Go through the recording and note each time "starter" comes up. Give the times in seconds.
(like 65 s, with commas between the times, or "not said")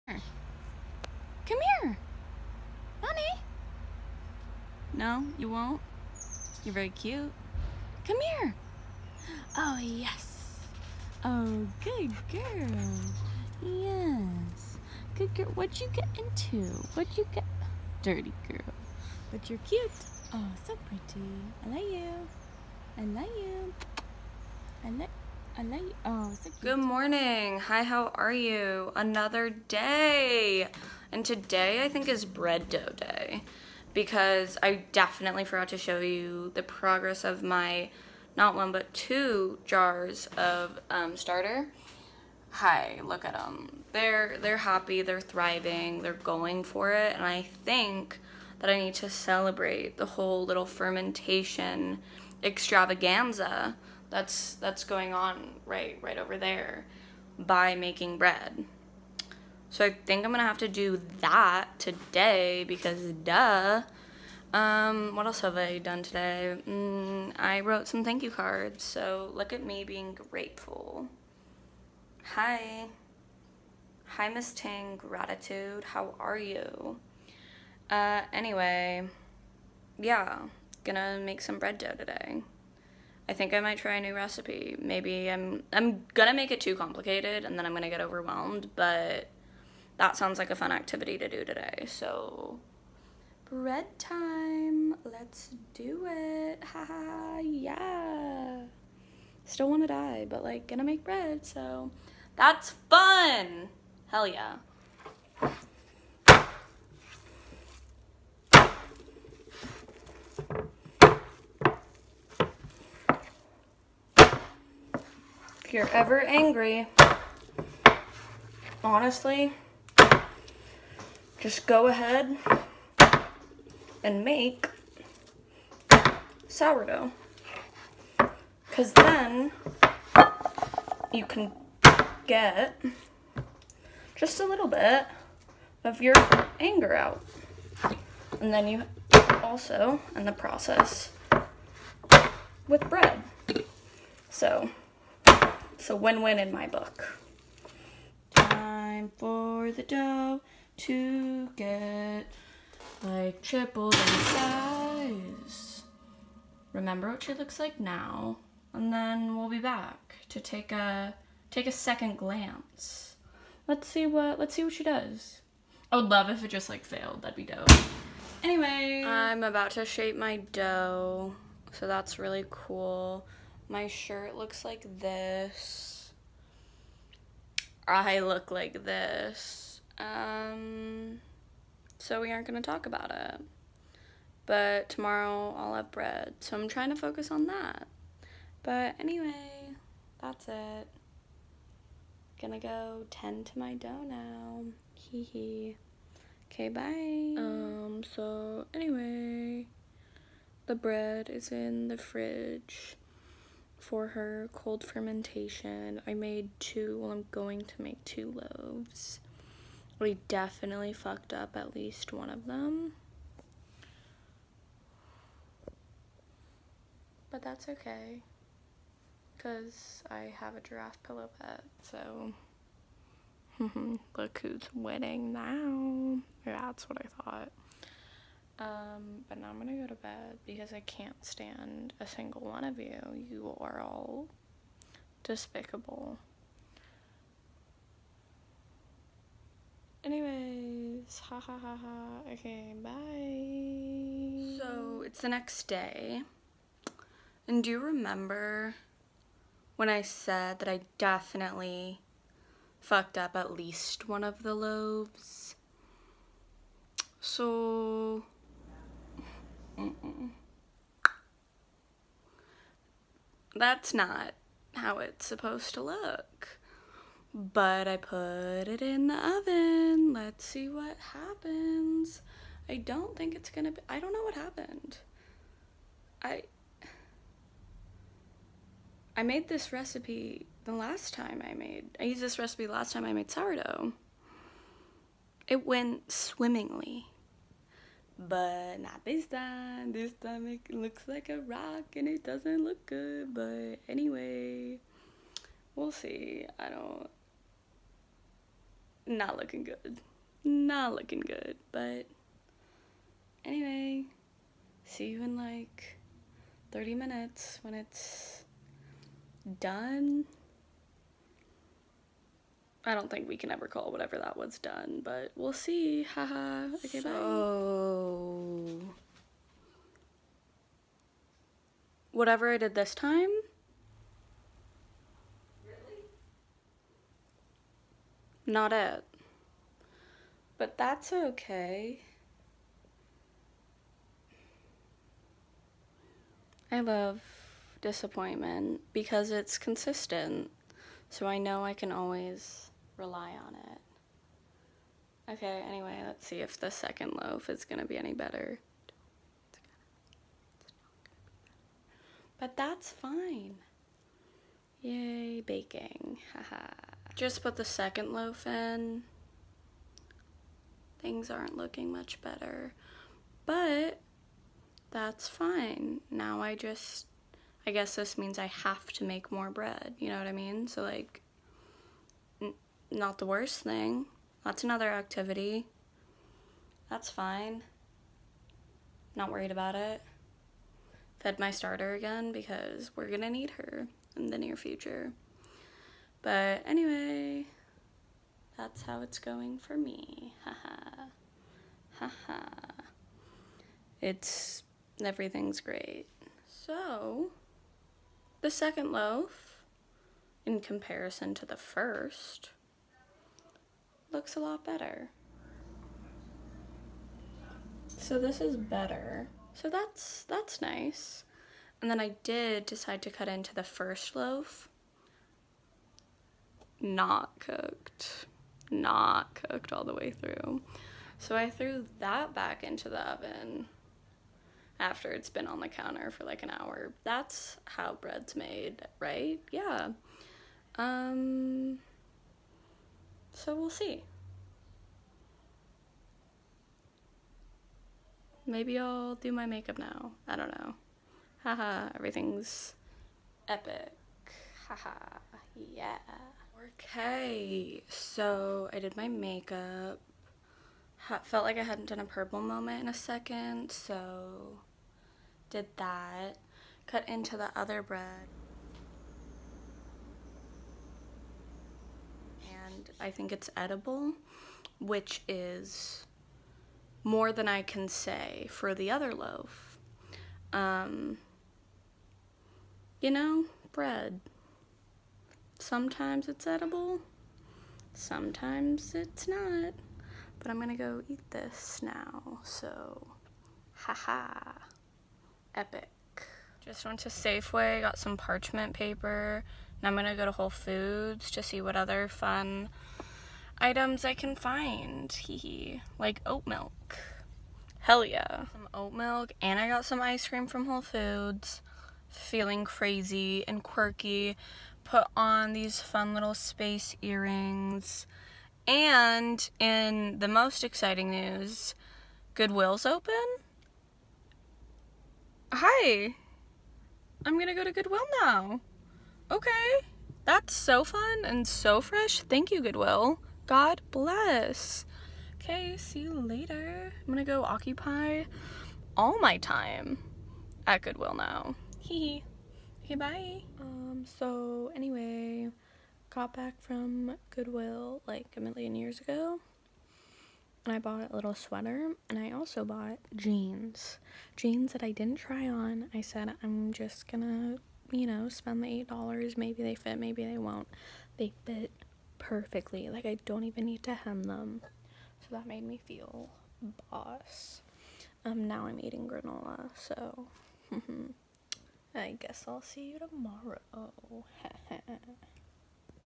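41 s, 381 s.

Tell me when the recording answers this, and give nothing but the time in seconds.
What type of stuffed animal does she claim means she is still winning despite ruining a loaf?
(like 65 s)
220 s.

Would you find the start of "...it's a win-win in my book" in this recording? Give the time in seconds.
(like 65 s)
145 s.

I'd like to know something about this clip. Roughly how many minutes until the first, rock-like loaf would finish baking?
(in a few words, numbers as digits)
30.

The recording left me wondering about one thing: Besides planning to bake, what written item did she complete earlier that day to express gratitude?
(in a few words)
Thank you cards.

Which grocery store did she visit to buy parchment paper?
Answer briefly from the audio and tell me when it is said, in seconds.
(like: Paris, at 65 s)
Safeway, at 487 s.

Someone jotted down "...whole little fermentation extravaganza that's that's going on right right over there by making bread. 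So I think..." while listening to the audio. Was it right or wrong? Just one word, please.
right.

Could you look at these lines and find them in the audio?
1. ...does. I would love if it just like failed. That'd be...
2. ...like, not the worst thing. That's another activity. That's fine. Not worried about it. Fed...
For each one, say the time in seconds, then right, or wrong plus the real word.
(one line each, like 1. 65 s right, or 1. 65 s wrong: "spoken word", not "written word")
1. 164 s right
2. 370 s right.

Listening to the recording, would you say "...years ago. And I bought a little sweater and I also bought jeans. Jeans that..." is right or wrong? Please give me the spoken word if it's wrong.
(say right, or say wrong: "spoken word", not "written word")
right.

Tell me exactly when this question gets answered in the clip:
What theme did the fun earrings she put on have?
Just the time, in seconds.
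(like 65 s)
506 s.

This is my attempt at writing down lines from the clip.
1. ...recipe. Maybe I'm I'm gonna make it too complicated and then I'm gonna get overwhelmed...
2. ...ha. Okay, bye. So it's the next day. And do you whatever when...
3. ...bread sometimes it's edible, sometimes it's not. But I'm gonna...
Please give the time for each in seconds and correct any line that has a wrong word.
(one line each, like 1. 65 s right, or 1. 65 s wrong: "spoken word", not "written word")
1. 84 s right
2. 241 s wrong: "remember", not "whatever"
3. 473 s right.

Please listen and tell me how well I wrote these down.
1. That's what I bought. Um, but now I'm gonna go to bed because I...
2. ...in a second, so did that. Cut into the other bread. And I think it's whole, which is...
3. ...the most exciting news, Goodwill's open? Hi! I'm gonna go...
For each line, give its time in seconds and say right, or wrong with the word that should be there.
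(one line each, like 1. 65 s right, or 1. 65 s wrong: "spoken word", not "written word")
1. 226 s wrong: "thought", not "bought"
2. 452 s wrong: "edible", not "whole"
3. 510 s right.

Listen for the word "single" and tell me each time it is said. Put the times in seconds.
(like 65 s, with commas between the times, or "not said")
232 s.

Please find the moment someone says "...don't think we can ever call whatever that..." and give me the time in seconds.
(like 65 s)
312 s.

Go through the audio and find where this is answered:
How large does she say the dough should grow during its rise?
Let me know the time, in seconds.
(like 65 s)
153 s.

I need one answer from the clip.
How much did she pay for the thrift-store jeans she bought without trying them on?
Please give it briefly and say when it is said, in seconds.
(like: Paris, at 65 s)
$8, at 548 s.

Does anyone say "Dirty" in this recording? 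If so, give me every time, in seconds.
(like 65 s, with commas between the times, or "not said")
18 s.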